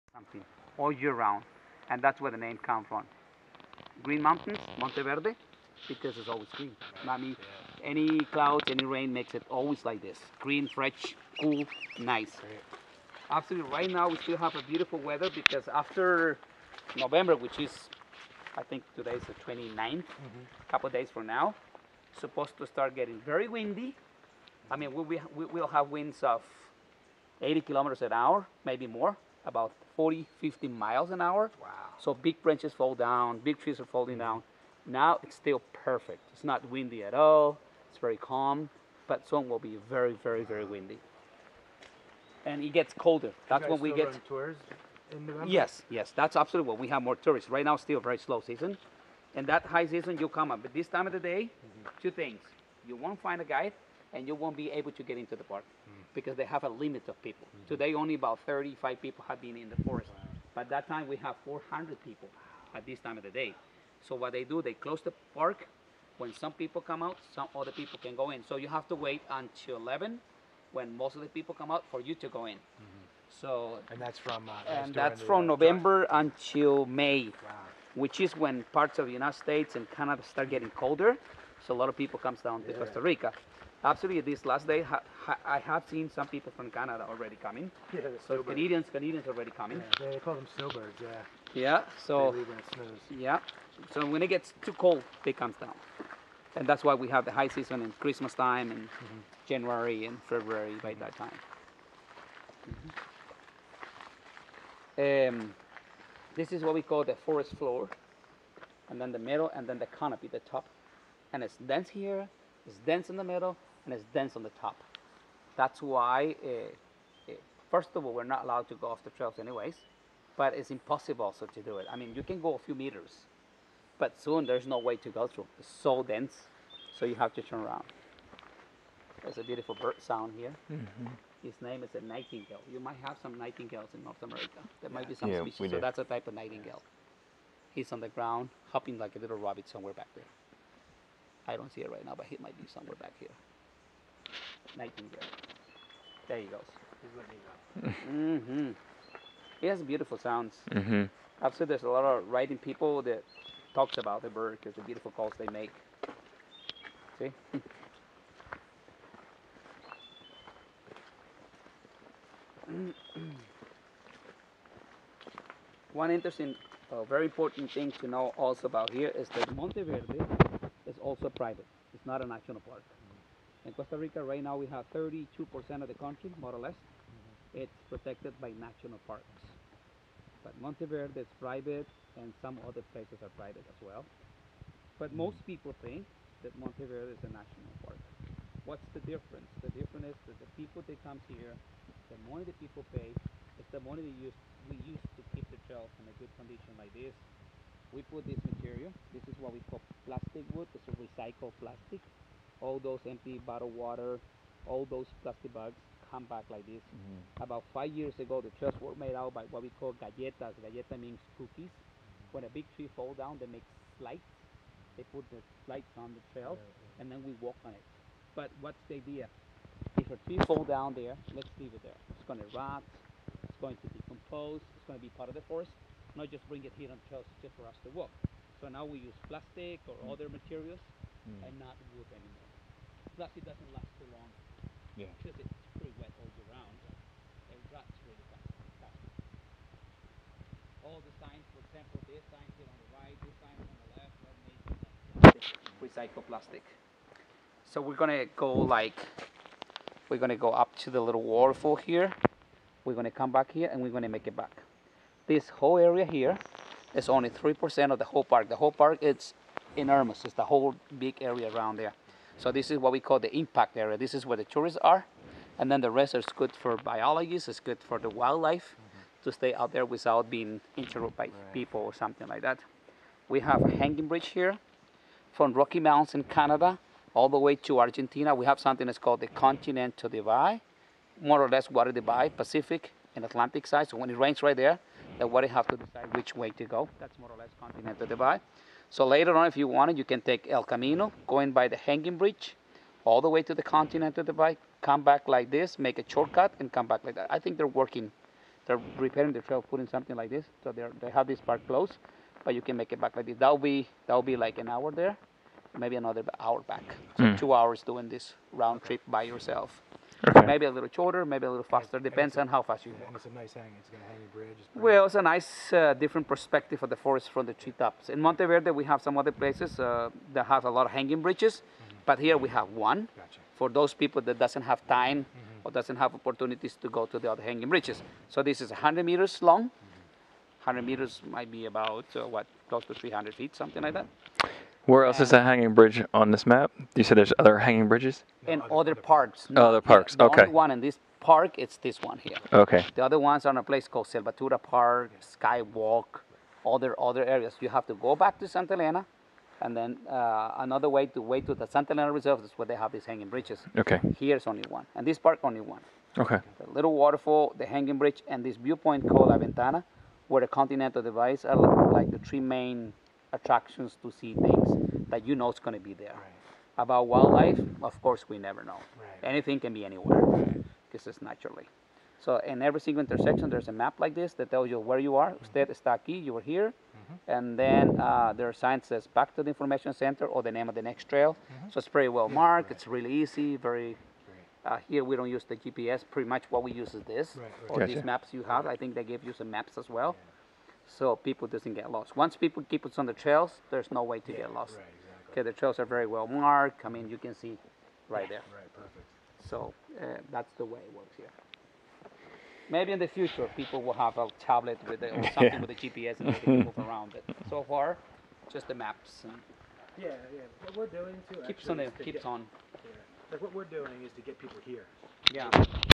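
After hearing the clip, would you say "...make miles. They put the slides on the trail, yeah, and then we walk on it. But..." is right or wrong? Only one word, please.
wrong.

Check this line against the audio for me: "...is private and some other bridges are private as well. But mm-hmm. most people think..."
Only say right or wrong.
wrong.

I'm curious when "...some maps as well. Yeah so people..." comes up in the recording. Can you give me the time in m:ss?
6:29.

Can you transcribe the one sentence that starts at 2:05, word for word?
It's so dense, so you have to turn around.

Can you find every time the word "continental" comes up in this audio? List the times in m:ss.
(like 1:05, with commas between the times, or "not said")
4:39, 4:47, 4:53, 6:00.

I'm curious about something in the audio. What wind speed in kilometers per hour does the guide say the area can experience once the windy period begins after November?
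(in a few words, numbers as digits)
80 kilometers an hour.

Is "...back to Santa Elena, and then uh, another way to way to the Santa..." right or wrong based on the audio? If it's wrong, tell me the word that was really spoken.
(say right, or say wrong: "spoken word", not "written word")
right.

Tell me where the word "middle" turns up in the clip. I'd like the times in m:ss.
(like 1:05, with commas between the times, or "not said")
1:49, 1:53.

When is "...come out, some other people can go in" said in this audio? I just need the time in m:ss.
1:06.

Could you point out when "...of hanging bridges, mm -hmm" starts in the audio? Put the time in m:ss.
5:20.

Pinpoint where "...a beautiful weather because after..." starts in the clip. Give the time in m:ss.
0:14.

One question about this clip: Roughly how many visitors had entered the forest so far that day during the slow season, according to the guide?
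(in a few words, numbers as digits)
35.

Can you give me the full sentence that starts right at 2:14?
There might be some yeah, species, so that's a type of nightingale.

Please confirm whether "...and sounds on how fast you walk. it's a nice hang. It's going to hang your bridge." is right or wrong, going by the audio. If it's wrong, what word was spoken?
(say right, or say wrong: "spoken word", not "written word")
wrong: "depends", not "sounds".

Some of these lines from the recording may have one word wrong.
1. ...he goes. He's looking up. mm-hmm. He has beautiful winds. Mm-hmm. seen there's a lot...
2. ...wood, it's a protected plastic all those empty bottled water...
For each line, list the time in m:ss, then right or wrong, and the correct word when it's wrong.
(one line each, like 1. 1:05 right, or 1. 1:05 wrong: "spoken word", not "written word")
1. 2:26 wrong: "sounds", not "winds"
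2. 3:20 wrong: "recycled", not "protected".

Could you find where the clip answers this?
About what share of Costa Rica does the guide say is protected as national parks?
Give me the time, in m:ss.
2:54.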